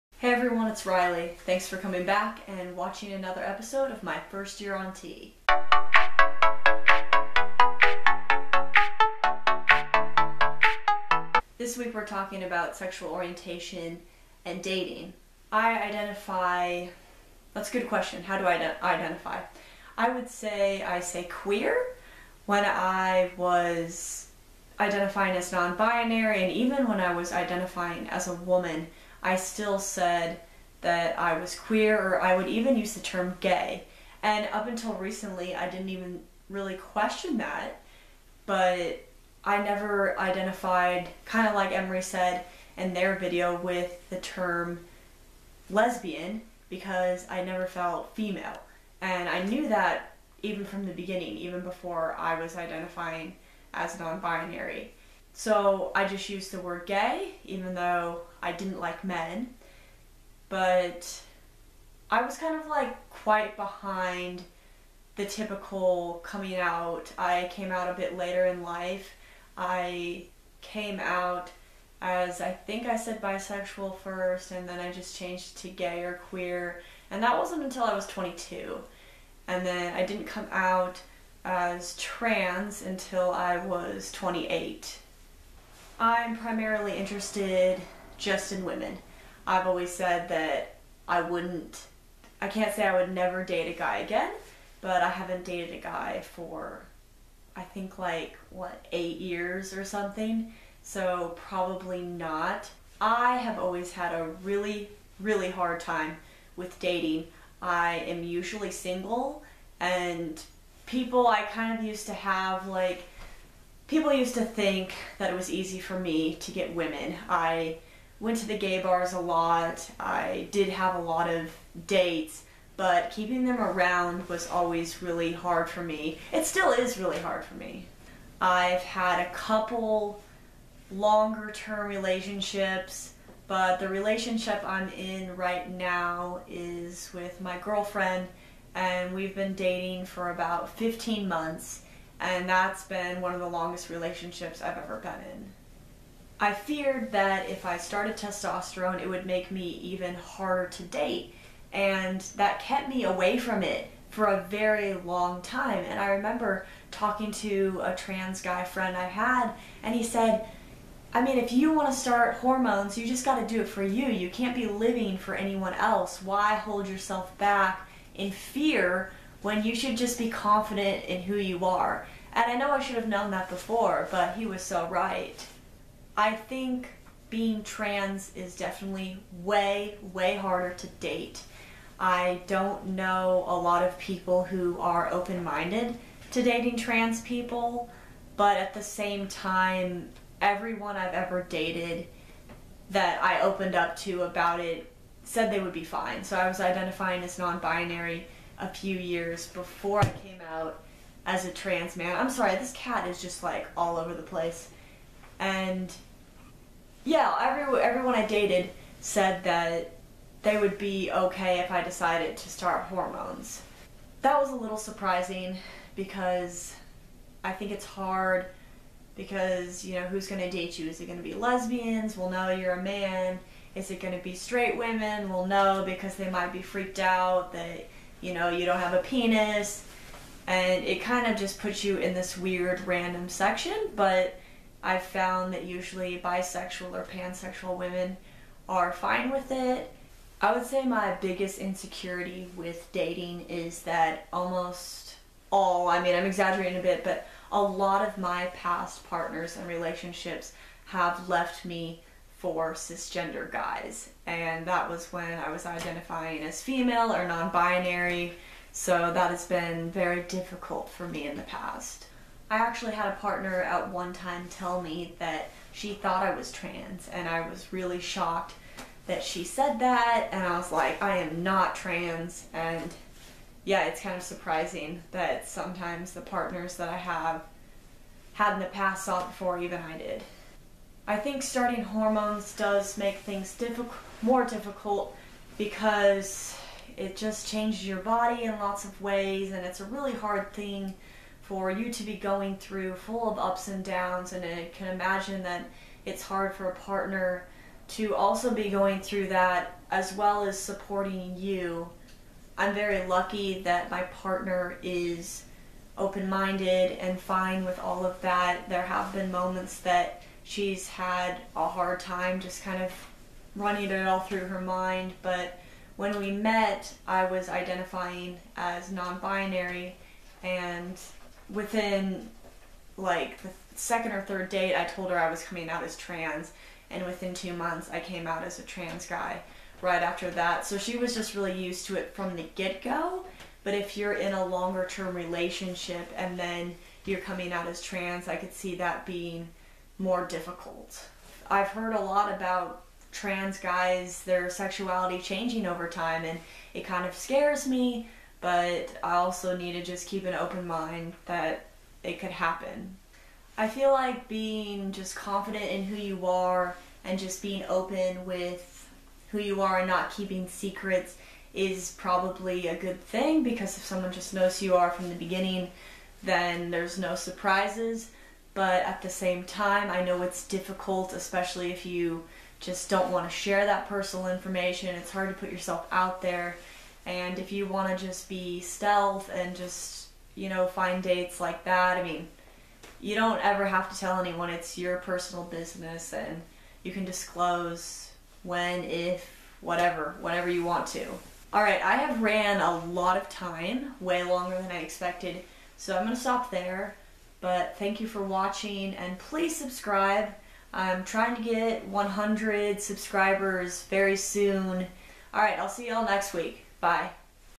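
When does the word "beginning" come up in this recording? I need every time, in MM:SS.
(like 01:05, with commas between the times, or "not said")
00:50, 06:05.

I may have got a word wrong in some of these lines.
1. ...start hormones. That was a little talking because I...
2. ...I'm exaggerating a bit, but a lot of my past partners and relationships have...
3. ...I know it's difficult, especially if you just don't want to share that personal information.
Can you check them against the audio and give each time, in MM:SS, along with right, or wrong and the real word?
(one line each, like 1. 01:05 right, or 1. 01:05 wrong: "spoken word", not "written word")
1. 03:32 wrong: "surprising", not "talking"
2. 04:06 right
3. 06:09 right.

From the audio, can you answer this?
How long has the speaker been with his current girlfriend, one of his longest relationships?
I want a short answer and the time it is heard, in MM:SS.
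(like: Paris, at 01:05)
15 months, at 02:20.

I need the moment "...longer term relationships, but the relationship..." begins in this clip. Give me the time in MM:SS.
02:10.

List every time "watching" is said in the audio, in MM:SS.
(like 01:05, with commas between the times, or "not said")
00:02, 06:38.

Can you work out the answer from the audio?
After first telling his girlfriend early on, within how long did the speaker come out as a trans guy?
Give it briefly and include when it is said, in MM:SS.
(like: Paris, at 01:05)
2 months, at 05:27.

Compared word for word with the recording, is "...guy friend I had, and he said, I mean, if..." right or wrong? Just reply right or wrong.
right.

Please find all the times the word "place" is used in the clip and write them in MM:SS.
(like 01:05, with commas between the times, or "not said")
03:24.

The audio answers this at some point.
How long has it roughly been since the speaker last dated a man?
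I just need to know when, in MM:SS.
01:38.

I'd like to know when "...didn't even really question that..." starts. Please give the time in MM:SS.
00:35.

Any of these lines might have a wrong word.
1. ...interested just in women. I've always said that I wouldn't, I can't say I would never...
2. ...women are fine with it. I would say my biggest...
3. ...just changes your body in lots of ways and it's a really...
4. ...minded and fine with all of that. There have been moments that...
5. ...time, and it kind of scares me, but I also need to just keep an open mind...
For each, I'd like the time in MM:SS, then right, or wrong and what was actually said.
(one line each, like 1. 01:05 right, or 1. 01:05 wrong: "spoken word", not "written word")
1. 01:26 right
2. 03:57 right
3. 04:47 right
4. 05:06 right
5. 05:45 right.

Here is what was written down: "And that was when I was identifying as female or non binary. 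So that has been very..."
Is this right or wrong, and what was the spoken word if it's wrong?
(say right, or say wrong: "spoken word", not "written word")
right.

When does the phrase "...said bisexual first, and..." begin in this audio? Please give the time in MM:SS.
01:12.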